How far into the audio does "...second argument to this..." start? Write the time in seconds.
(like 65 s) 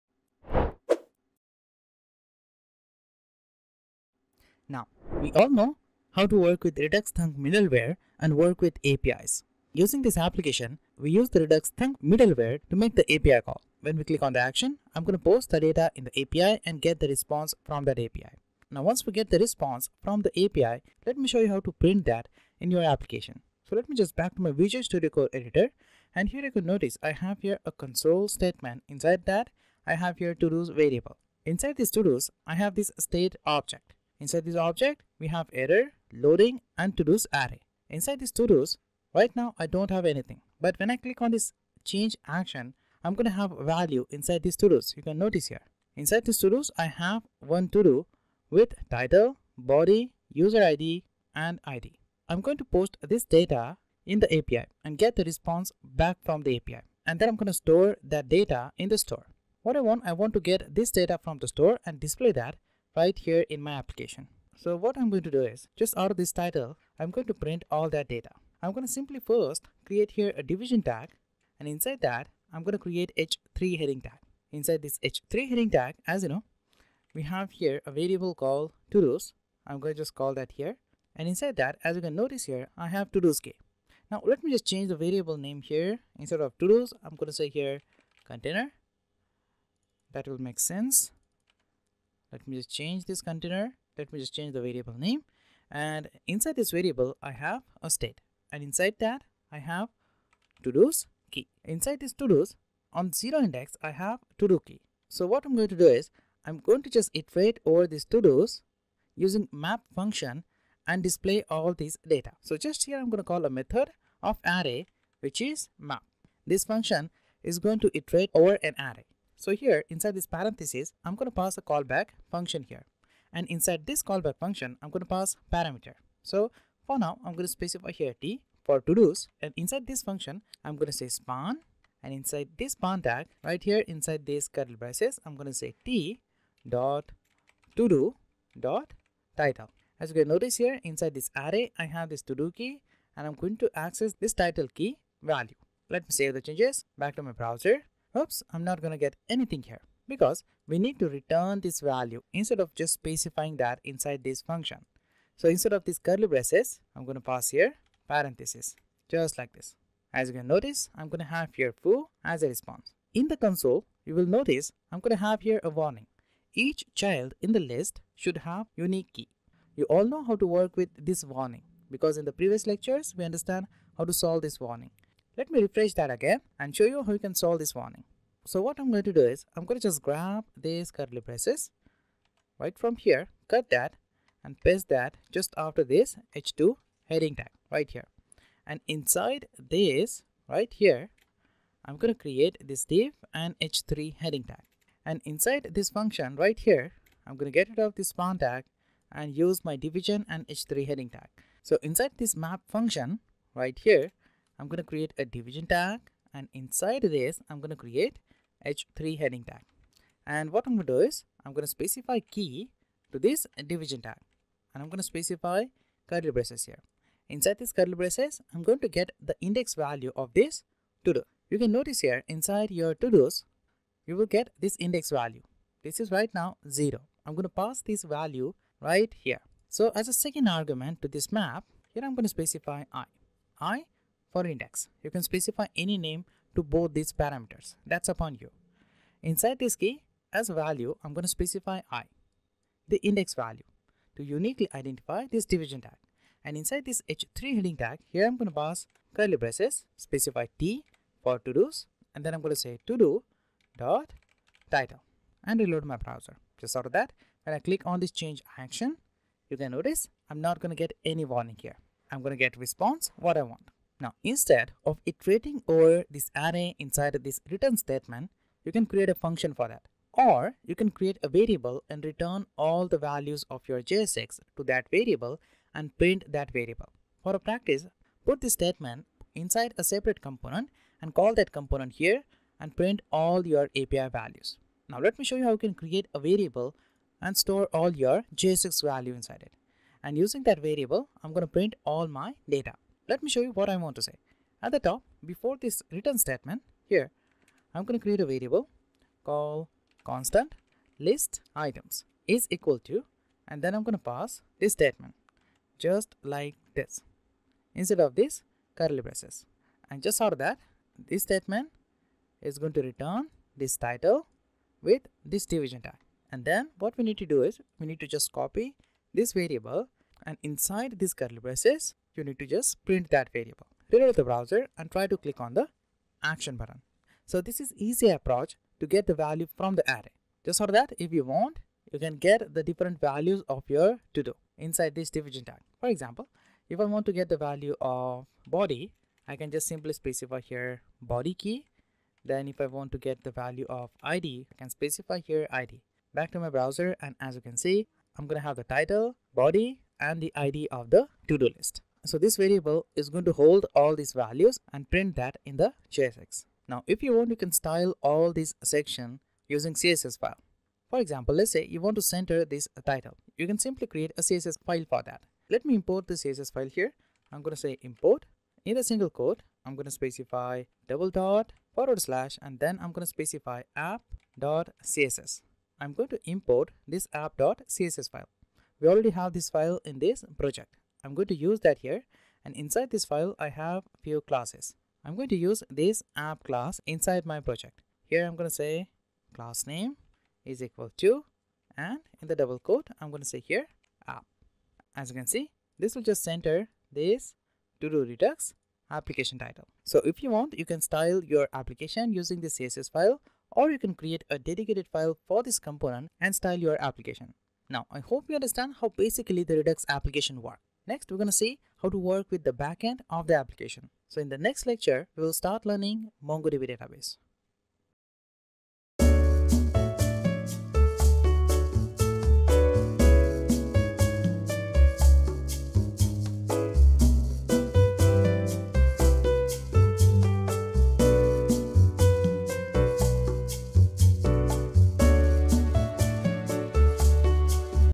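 230 s.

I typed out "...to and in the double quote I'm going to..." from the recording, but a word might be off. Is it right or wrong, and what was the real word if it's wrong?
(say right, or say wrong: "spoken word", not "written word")
right.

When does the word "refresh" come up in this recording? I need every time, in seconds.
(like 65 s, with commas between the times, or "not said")
175 s.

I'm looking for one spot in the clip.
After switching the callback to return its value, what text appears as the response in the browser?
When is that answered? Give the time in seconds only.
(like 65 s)
161 s.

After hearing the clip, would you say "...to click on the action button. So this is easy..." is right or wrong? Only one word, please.
right.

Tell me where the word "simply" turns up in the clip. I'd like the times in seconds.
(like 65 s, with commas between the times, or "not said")
68 s, 339 s, 363 s.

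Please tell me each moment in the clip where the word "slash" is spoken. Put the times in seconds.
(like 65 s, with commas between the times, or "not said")
372 s.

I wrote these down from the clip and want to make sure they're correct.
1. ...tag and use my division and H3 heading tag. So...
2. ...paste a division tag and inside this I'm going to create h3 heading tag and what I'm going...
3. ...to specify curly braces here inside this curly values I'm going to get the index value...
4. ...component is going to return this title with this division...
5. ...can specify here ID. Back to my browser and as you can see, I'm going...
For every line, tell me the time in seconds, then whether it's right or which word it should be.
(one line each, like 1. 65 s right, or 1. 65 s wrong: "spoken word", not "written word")
1. 198 s right
2. 204 s wrong: "create", not "paste"
3. 215 s wrong: "braces", not "values"
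4. 311 s wrong: "statement", not "component"
5. 344 s right.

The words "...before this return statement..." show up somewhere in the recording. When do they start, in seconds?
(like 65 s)
295 s.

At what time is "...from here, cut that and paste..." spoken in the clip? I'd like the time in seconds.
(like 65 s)
182 s.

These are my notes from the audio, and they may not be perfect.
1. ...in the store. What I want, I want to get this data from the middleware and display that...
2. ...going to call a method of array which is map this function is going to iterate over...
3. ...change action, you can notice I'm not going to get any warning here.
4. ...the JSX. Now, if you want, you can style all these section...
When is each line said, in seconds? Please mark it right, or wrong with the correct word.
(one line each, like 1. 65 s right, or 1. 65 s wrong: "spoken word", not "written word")
1. 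58 s wrong: "store", not "middleware"
2. 113 s right
3. 258 s right
4. 355 s right.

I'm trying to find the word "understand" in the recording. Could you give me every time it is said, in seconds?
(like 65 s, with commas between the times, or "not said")
173 s, 408 s.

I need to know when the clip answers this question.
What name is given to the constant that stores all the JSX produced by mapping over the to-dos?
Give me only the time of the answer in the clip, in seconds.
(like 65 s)
301 s.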